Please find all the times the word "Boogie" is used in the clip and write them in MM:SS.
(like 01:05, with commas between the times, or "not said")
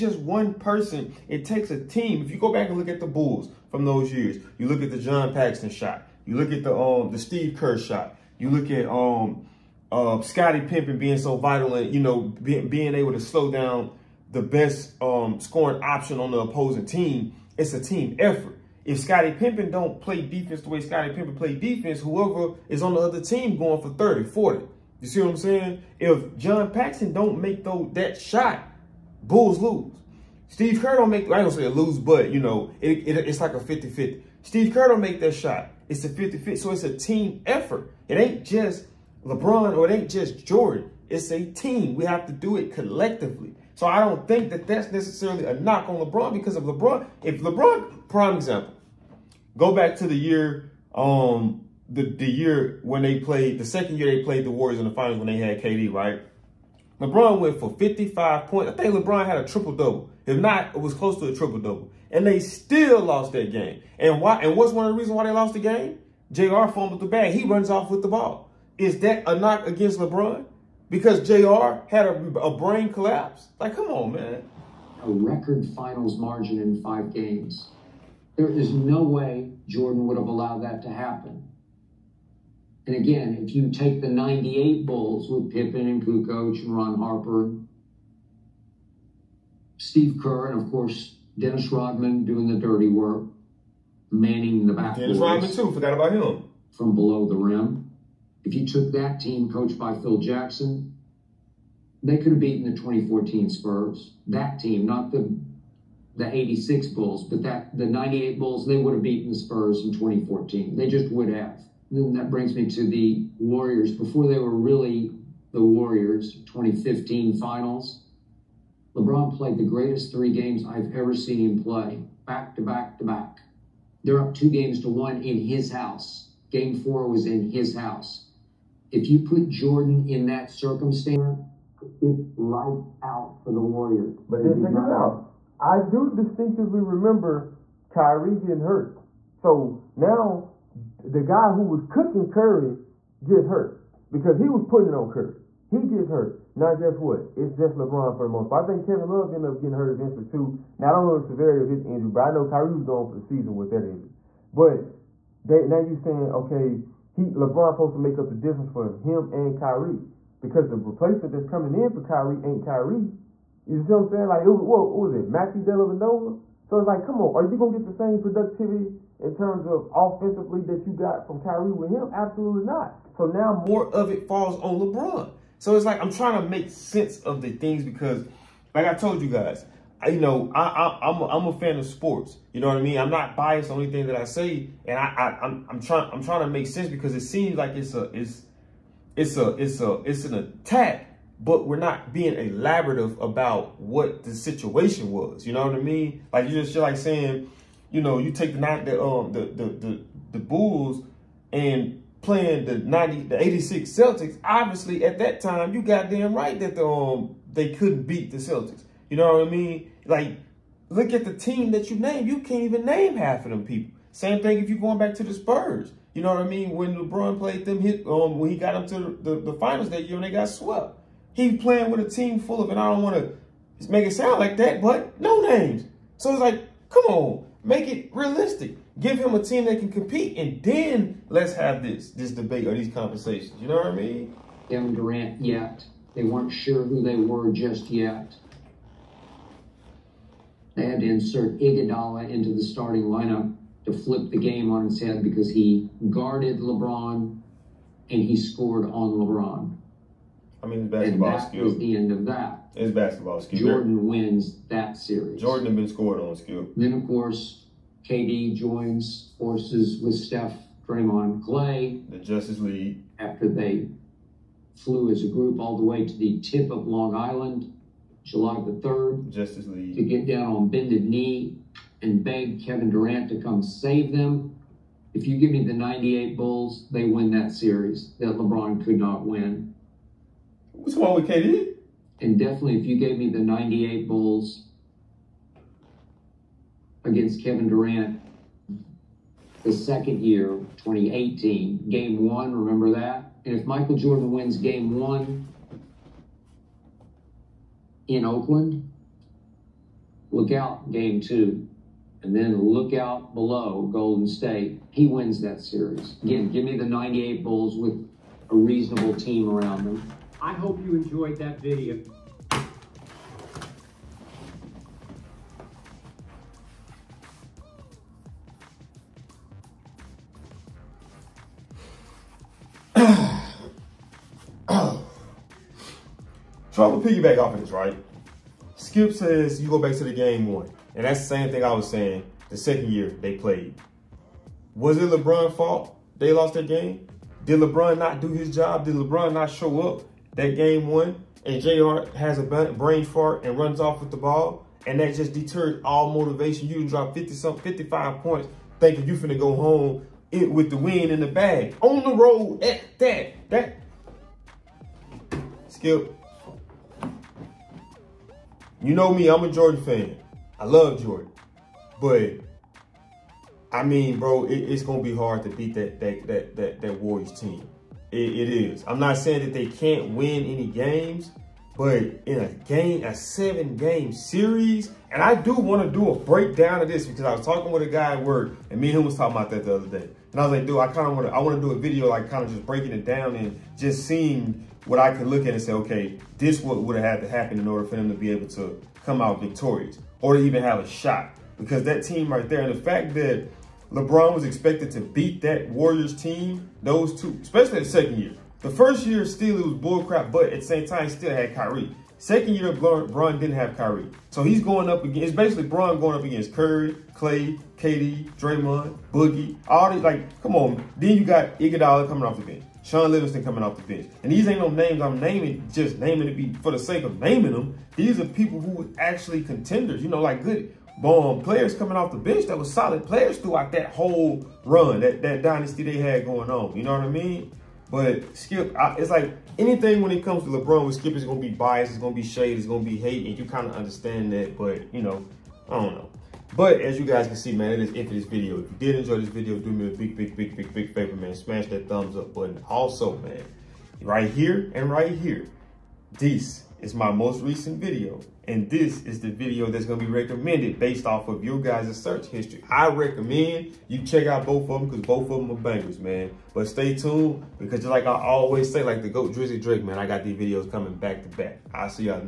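06:49.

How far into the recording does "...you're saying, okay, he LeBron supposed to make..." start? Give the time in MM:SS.
02:35.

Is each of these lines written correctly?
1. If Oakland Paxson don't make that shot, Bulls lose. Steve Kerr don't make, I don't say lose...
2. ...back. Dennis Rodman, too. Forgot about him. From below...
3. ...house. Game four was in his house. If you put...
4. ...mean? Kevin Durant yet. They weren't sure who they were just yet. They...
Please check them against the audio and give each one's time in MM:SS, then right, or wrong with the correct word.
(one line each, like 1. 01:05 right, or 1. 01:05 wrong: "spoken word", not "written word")
1. 00:25 wrong: "John", not "Oakland"
2. 01:34 right
3. 02:05 right
4. 03:53 right.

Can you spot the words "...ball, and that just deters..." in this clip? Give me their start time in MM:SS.
05:44.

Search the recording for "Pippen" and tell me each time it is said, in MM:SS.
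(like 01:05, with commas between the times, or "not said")
00:10, 01:25.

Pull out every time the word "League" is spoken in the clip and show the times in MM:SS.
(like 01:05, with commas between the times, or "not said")
04:22, 04:29.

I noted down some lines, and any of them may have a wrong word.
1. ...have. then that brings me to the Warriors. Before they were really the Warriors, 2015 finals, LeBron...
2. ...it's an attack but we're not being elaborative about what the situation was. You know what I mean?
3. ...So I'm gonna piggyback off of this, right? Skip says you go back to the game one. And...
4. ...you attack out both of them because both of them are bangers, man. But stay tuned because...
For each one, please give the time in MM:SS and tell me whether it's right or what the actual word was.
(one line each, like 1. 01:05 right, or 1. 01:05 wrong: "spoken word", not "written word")
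1. 01:51 right
2. 03:10 right
3. 05:26 right
4. 07:33 wrong: "check", not "attack".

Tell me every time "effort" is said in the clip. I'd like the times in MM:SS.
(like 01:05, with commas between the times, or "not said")
00:18, 00:37.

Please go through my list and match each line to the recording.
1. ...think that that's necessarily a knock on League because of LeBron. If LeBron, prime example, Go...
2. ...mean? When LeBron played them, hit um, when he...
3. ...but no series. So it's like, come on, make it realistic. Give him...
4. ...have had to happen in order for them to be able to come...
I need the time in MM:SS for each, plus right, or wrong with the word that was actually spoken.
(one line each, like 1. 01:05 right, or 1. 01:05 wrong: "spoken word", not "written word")
1. 00:44 wrong: "LeBron", not "League"
2. 03:36 right
3. 03:44 wrong: "names", not "series"
4. 06:26 right.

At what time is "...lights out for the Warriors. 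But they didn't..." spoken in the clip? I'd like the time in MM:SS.
02:12.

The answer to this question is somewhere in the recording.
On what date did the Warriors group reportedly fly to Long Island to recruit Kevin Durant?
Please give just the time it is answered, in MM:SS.
04:28.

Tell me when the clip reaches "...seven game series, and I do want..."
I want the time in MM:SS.
06:13.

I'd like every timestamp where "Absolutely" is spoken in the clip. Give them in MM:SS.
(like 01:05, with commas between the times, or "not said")
02:52.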